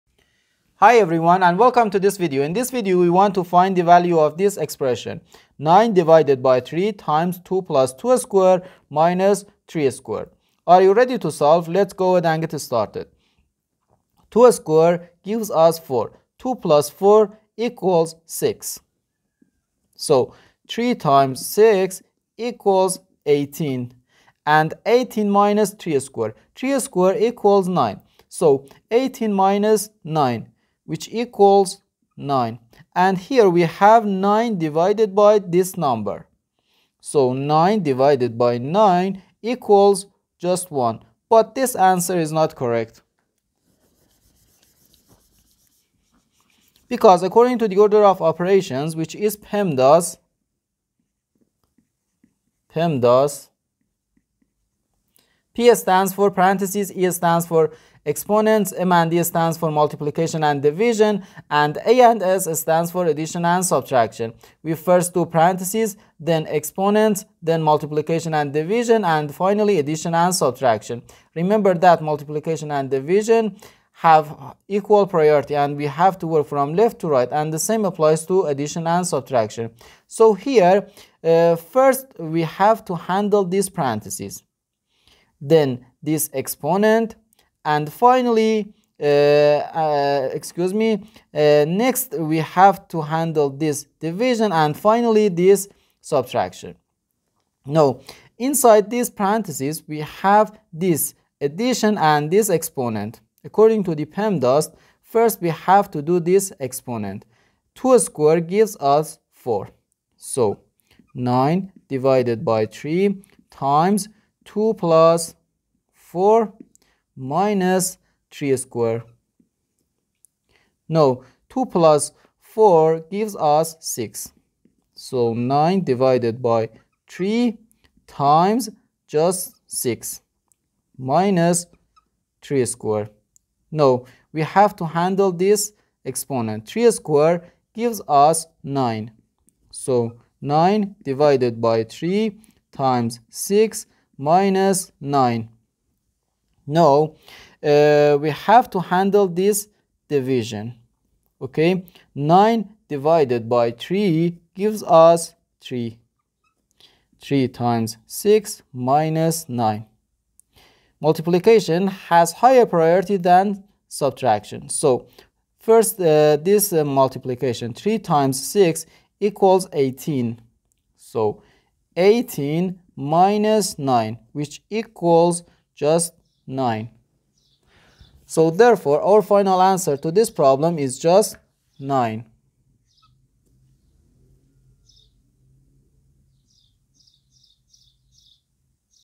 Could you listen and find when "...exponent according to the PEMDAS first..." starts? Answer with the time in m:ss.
1:42.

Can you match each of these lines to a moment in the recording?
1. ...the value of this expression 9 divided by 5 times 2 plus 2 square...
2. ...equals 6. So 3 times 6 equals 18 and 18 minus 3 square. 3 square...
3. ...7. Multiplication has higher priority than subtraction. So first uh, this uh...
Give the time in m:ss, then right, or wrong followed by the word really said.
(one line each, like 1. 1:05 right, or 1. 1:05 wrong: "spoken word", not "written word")
1. 0:03 wrong: "3", not "5"
2. 0:17 right
3. 2:39 wrong: "9", not "7".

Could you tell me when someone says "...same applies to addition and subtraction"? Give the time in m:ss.
1:17.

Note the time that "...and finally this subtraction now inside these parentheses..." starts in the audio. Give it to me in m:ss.
1:34.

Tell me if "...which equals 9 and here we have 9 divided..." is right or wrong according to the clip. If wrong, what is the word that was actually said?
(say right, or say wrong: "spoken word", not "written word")
right.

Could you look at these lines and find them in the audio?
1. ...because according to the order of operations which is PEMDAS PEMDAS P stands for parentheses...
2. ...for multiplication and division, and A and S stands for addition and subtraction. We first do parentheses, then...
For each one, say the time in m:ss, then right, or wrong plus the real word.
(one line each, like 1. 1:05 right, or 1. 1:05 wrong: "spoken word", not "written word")
1. 0:46 right
2. 0:59 right.